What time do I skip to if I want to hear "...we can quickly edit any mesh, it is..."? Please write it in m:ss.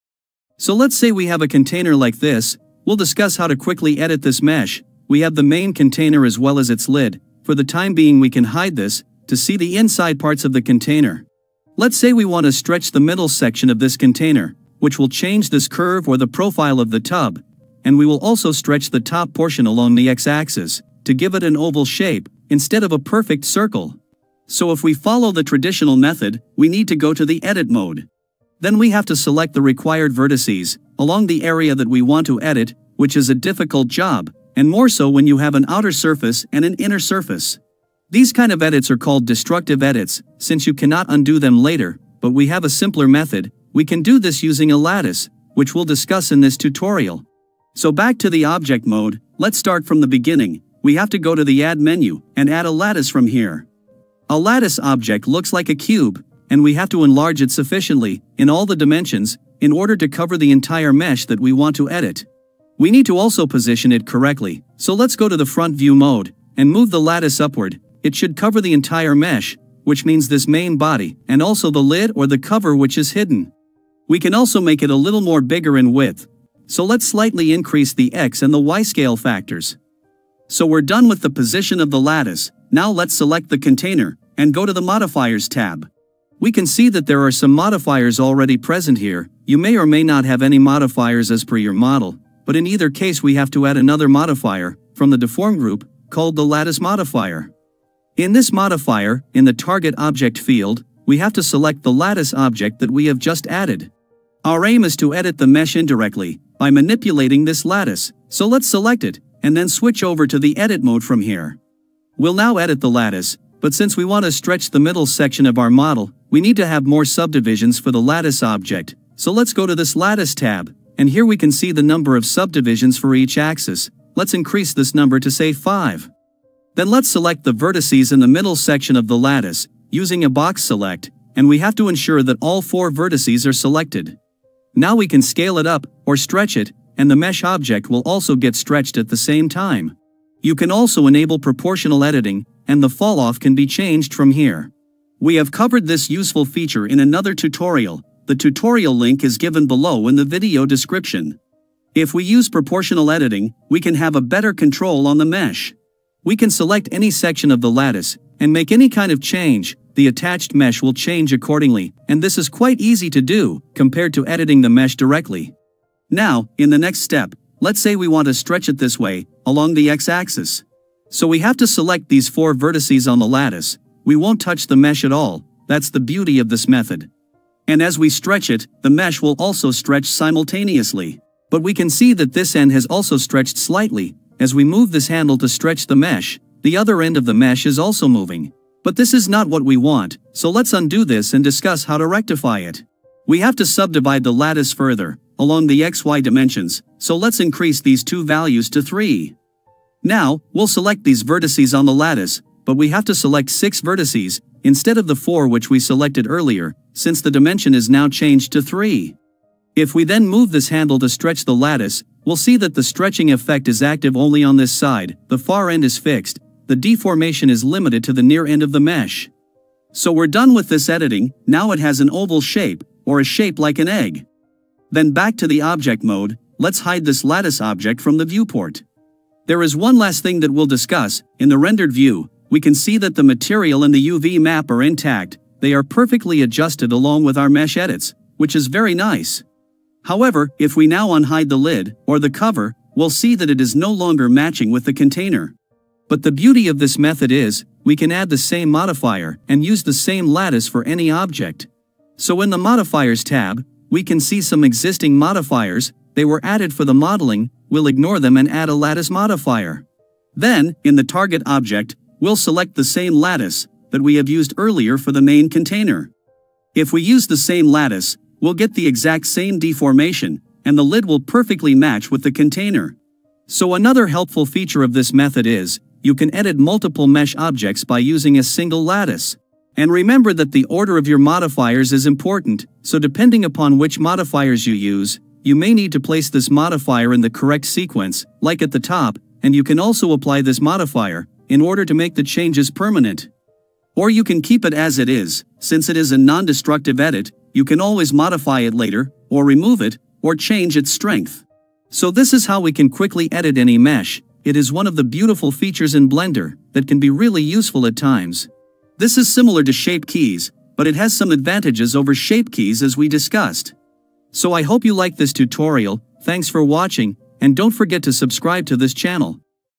5:02.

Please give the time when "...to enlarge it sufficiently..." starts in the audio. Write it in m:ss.
0:56.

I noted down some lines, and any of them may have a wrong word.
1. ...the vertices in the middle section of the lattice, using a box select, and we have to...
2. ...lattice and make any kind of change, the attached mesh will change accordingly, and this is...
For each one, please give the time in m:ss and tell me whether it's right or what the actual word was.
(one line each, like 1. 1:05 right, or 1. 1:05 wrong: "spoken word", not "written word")
1. 2:07 right
2. 2:37 right.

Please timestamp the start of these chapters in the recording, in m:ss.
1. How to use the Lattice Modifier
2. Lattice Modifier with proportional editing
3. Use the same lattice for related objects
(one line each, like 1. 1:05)
1. 0:51
2. 2:32
3. 3:49.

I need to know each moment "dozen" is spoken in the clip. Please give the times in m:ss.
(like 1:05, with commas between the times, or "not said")
not said.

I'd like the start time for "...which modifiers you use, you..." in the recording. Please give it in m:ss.
4:43.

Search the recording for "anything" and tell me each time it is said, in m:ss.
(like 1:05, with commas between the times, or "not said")
not said.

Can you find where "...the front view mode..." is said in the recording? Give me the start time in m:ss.
1:05.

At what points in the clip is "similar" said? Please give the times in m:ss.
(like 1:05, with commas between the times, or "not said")
5:09.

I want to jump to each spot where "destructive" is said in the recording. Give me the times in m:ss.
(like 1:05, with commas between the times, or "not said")
0:39, 4:56.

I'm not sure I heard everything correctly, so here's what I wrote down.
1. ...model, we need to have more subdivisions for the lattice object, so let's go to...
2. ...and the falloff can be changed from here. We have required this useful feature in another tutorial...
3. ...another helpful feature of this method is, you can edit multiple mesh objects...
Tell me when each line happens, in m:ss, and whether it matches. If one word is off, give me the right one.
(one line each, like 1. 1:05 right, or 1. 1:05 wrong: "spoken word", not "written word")
1. 1:55 right
2. 2:22 wrong: "covered", not "required"
3. 4:33 right.